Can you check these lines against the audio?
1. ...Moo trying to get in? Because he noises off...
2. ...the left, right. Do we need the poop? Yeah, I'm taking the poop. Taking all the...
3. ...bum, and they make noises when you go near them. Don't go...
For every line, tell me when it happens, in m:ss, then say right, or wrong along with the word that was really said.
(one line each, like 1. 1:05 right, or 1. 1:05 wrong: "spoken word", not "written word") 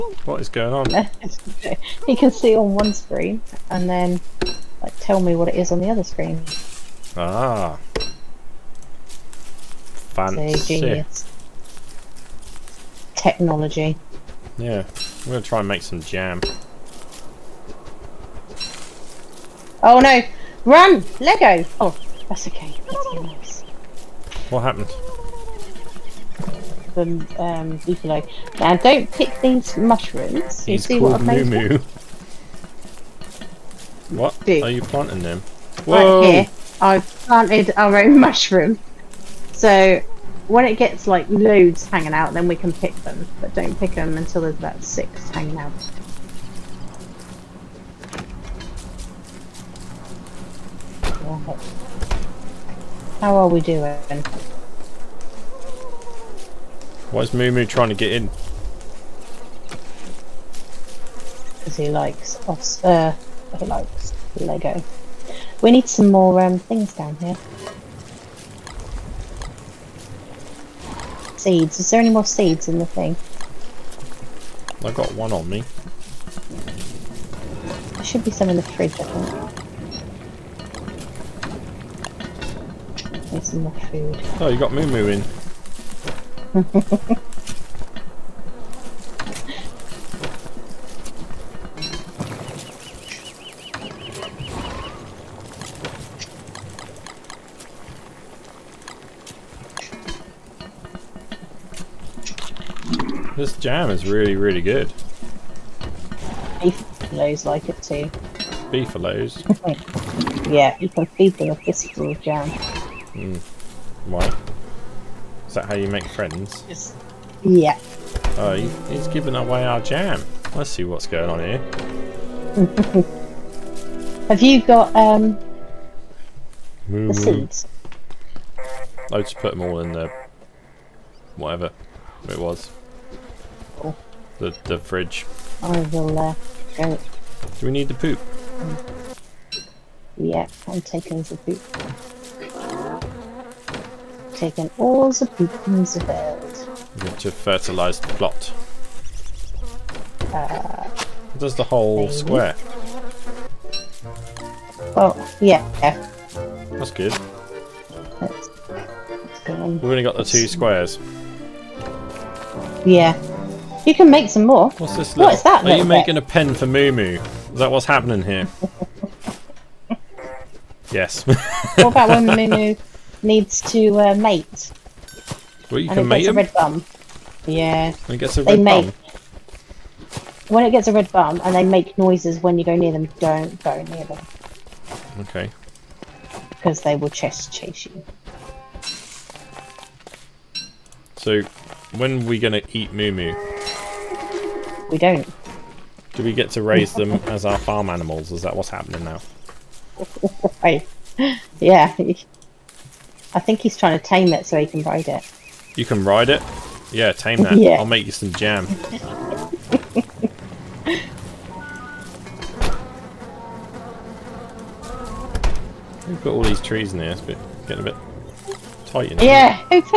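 1. 0:57 wrong: "likes", not "noises"
2. 2:15 right
3. 3:01 right.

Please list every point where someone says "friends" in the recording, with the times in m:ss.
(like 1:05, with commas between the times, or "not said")
1:56.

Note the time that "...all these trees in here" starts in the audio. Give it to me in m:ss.
3:36.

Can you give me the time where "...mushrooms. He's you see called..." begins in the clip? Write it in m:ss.
0:29.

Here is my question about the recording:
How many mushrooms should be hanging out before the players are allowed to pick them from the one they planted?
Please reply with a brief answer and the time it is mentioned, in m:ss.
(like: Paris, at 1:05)
6, at 0:44.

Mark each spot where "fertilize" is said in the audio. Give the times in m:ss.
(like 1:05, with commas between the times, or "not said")
2:27.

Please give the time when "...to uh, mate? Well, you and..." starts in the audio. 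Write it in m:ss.
2:53.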